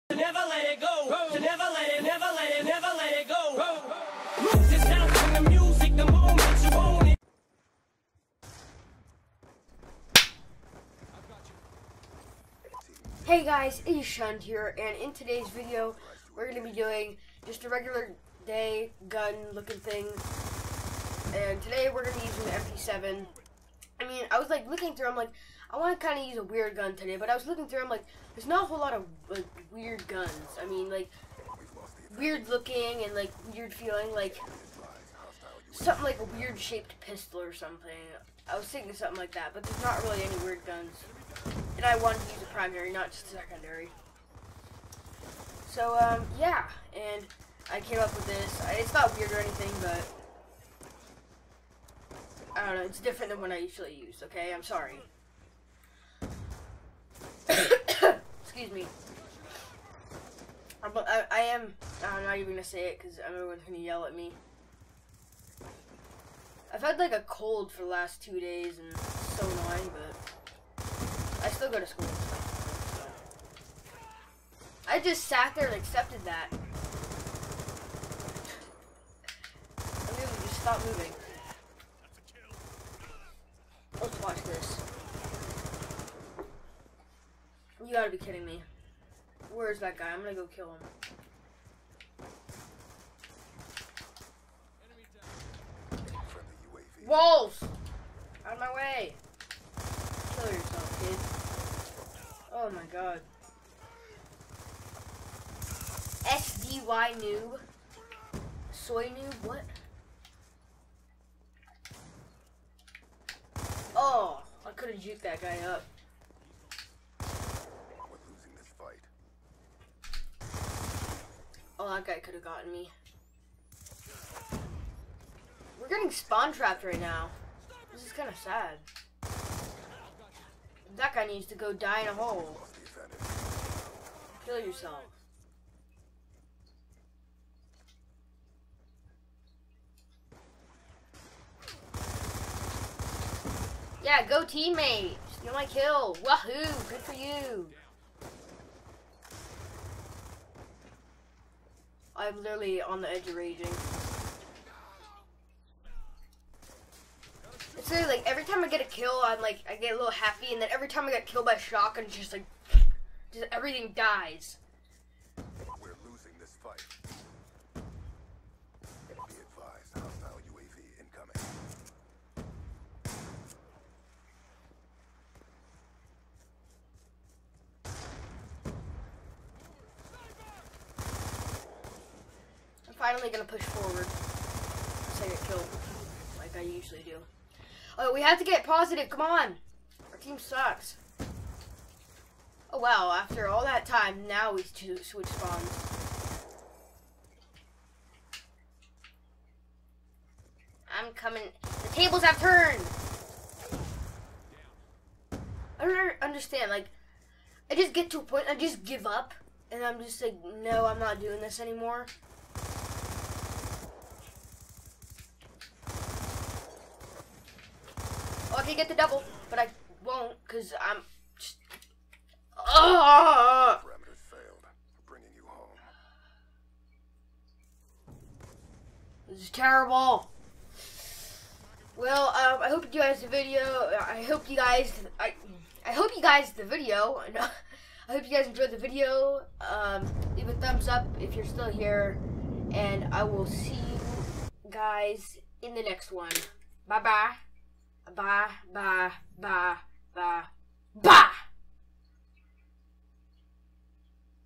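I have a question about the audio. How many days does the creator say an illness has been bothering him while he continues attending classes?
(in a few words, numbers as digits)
2.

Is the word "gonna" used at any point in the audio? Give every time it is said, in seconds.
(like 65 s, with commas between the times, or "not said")
80 s, 90 s, 183 s.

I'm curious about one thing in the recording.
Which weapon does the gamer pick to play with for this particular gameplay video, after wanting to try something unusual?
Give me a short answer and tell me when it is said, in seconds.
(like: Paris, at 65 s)
MP7, at 22 s.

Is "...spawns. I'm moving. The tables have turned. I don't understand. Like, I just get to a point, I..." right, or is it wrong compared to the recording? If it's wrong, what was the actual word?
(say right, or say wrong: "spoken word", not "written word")
wrong: "coming", not "moving".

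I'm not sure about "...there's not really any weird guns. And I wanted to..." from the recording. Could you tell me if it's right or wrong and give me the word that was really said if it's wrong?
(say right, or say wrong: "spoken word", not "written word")
right.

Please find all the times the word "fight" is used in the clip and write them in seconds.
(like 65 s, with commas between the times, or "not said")
118 s, 166 s.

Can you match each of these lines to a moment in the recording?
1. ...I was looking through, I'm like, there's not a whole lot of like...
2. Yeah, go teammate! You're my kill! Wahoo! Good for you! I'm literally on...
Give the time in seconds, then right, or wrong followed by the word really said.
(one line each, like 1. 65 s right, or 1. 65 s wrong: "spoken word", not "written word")
1. 27 s right
2. 144 s right.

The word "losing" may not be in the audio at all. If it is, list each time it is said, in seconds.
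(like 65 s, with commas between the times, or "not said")
117 s, 166 s.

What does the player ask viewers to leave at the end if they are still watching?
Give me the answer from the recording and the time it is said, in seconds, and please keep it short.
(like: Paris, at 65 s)
a thumbs up, at 240 s.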